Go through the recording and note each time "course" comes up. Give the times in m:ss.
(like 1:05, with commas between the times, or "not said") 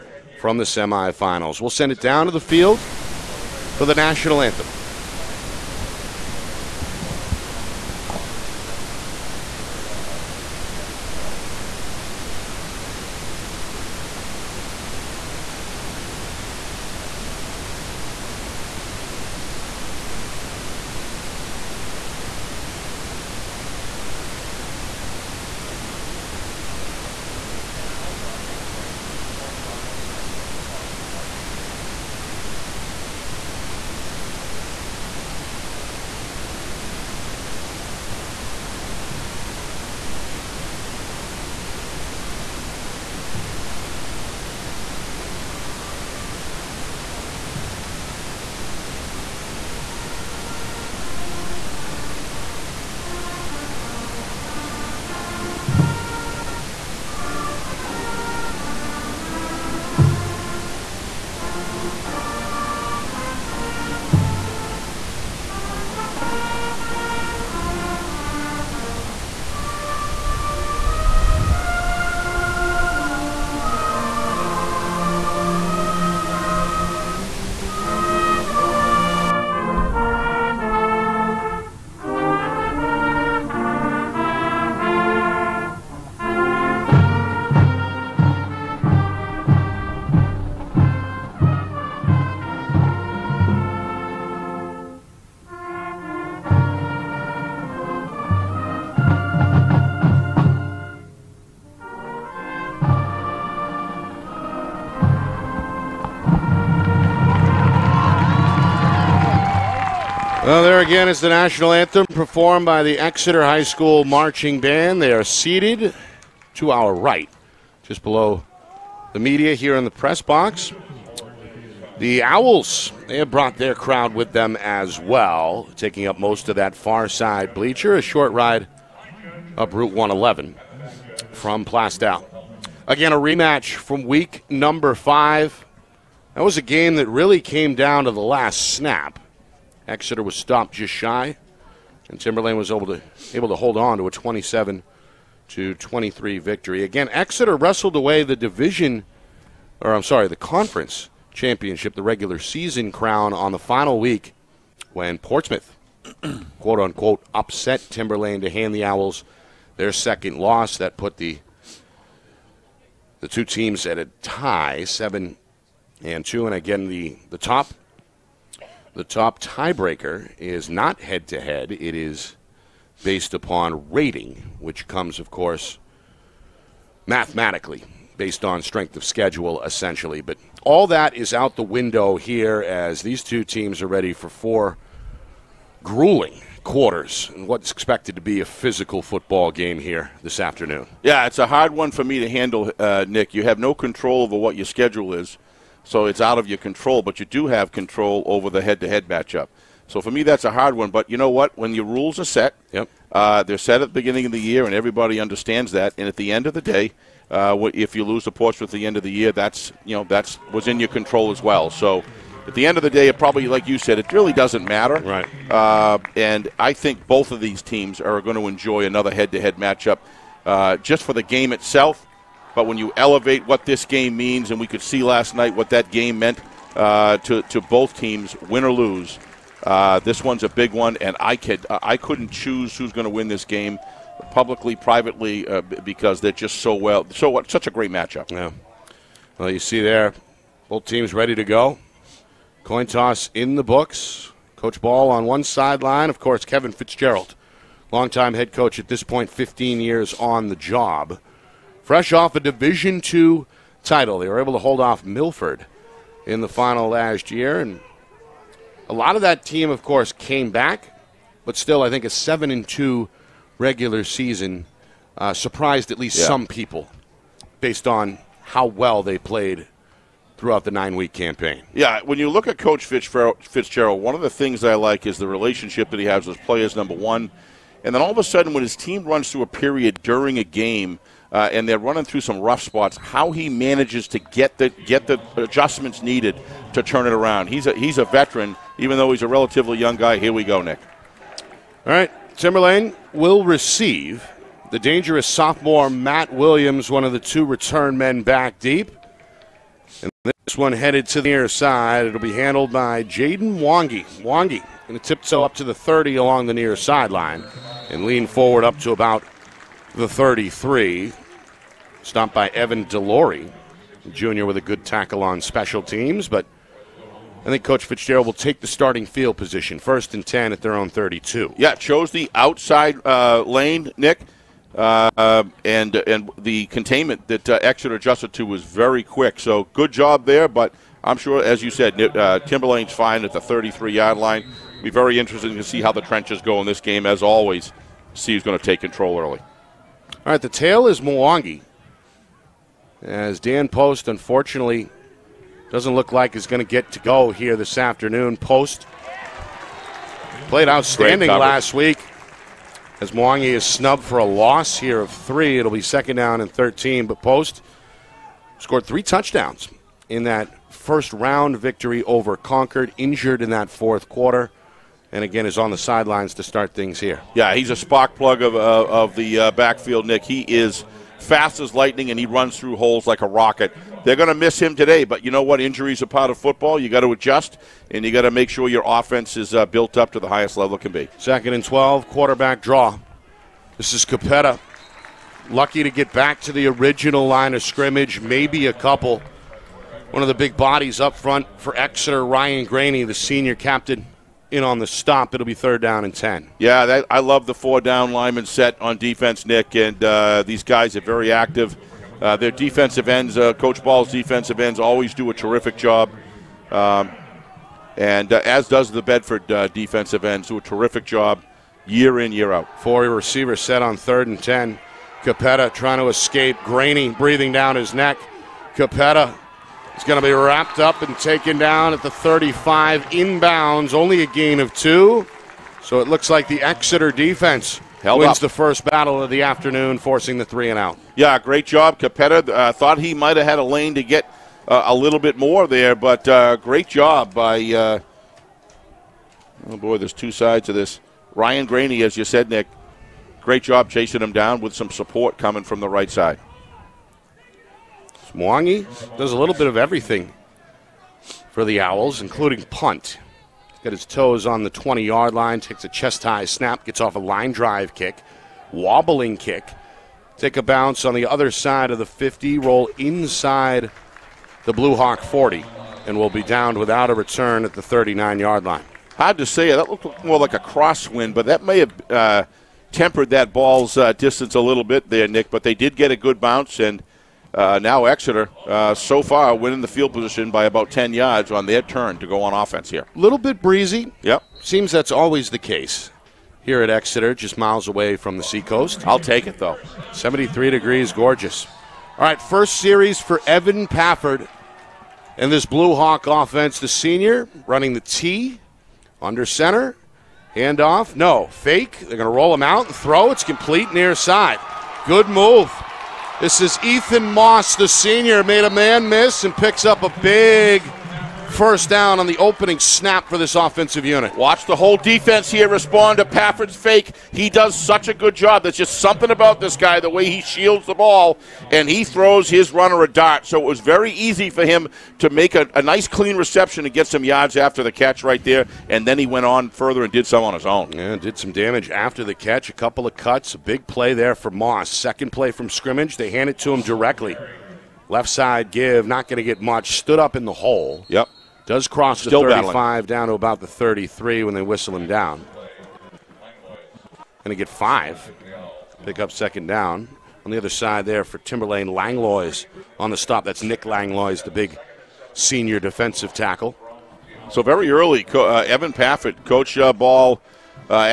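2:55, 4:06, 4:19.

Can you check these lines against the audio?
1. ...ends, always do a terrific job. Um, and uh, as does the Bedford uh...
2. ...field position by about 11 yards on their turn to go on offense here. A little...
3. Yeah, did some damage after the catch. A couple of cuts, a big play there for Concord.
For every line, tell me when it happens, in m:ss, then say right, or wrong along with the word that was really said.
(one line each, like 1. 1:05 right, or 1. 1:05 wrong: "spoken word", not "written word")
1. 6:44 right
2. 7:59 wrong: "10", not "11"
3. 8:50 wrong: "Moss", not "Concord".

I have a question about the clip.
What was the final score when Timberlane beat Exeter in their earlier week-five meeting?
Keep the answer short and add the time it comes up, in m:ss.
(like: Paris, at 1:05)
27 to 23, at 2:24.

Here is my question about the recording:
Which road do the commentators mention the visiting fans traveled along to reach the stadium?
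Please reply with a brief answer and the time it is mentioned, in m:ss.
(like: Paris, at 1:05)
Route 111, at 2:09.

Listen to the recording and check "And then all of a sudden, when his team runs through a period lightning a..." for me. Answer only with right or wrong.
wrong.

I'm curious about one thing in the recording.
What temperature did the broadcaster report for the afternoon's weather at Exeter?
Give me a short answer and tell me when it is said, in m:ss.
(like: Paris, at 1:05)
73 degrees, at 8:10.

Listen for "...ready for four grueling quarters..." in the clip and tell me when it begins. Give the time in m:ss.
3:03.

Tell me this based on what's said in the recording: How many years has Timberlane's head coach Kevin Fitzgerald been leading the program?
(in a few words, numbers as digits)
15 years.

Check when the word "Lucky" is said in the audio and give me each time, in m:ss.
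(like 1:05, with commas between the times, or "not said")
6:25.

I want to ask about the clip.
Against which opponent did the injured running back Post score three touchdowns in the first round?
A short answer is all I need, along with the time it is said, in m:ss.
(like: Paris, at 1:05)
Concord, at 6:02.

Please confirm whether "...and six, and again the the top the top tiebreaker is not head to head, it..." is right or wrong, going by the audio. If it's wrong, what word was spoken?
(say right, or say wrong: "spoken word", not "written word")
wrong: "two", not "six".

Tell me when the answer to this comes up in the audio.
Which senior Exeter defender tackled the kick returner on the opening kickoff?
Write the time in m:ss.
5:12.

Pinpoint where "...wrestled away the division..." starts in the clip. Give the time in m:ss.
2:27.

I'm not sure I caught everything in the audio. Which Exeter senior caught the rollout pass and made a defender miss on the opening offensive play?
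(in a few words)
Ethan Moss.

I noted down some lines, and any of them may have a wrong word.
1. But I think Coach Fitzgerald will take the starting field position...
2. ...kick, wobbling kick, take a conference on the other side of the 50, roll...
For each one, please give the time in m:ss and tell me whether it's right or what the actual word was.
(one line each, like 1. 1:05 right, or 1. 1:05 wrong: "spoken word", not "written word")
1. 5:16 right
2. 7:37 wrong: "bounce", not "conference".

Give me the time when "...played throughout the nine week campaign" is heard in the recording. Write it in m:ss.
4:29.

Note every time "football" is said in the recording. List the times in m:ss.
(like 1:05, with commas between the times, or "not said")
3:09, 6:16.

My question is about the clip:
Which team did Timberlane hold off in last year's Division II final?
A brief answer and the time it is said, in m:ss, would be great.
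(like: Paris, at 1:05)
Milford, at 4:15.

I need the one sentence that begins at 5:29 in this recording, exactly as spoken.
So good job there, but I'm sure, as you said, uh, Timberlane's fine at the 33 yard line.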